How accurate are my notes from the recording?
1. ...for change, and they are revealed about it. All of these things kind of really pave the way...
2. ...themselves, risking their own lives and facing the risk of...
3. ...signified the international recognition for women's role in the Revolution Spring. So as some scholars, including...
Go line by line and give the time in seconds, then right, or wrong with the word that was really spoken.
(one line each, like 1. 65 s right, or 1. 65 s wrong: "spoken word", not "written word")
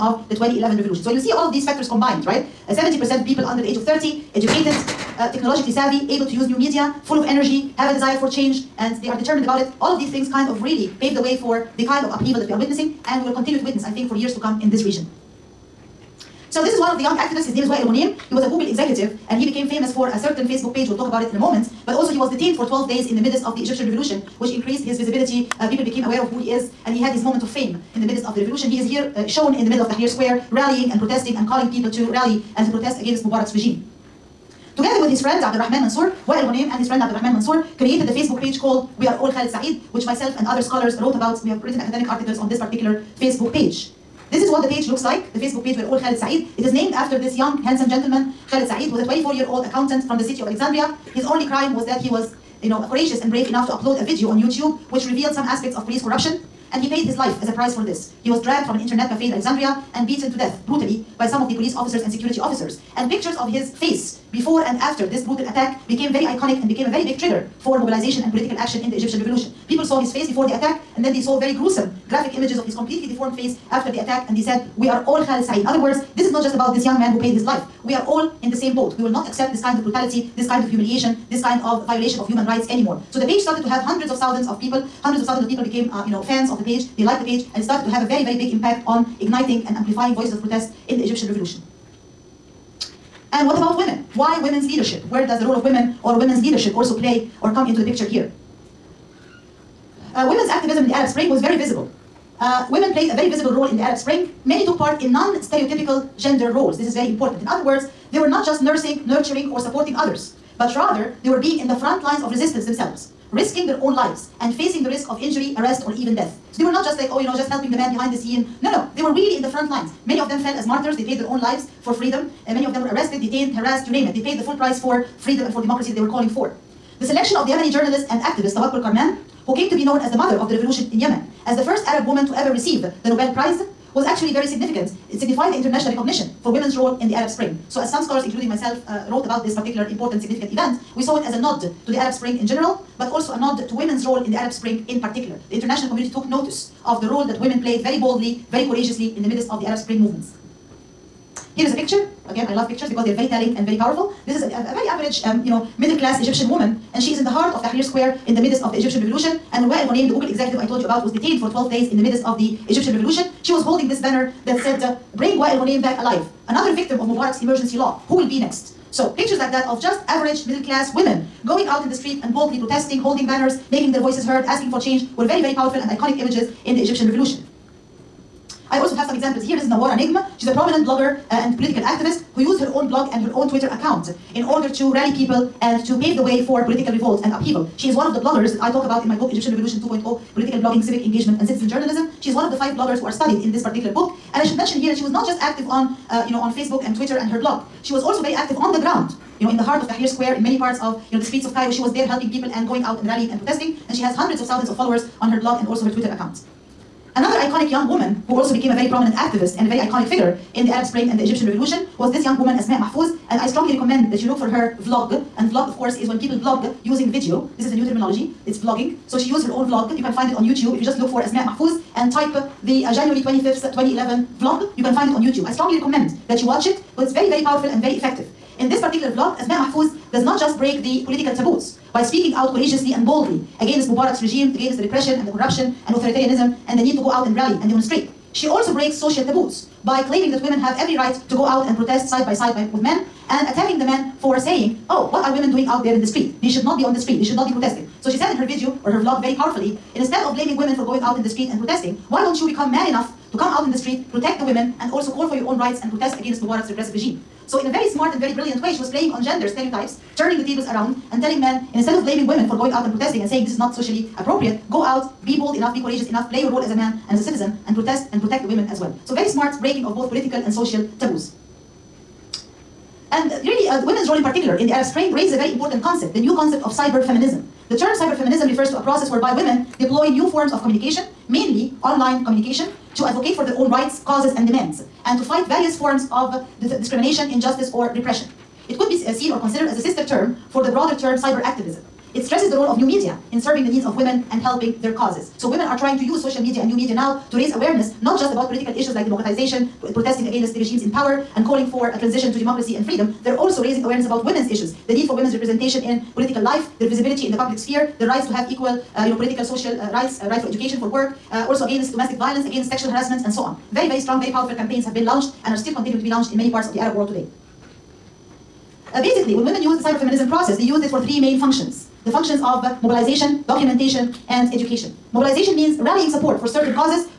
1. 8 s wrong: "determined", not "revealed"
2. 112 s right
3. 135 s wrong: "Arab", not "Revolution".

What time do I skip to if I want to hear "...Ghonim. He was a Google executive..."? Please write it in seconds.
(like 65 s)
17 s.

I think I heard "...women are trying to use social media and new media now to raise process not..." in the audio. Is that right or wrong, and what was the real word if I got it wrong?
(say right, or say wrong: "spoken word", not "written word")
wrong: "awareness", not "process".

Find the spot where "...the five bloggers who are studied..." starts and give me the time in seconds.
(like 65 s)
192 s.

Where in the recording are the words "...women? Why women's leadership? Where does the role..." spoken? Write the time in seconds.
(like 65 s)
93 s.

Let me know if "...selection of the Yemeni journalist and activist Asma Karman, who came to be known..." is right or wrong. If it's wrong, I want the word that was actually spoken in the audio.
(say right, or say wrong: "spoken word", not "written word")
wrong: "Tawakkul", not "Asma".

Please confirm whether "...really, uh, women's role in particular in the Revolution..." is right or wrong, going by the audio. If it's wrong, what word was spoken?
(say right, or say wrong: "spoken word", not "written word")
wrong: "Arab", not "Revolution".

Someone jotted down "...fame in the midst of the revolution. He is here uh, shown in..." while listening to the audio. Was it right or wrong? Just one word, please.
right.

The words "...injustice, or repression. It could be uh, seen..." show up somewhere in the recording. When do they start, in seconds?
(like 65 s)
287 s.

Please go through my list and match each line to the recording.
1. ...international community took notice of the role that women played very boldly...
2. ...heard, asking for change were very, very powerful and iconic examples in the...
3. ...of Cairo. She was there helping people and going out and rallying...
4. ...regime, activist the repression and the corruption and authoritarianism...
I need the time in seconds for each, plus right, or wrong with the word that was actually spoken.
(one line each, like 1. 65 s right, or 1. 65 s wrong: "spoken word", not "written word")
1. 145 s right
2. 174 s wrong: "images", not "examples"
3. 201 s right
4. 234 s wrong: "against", not "activist".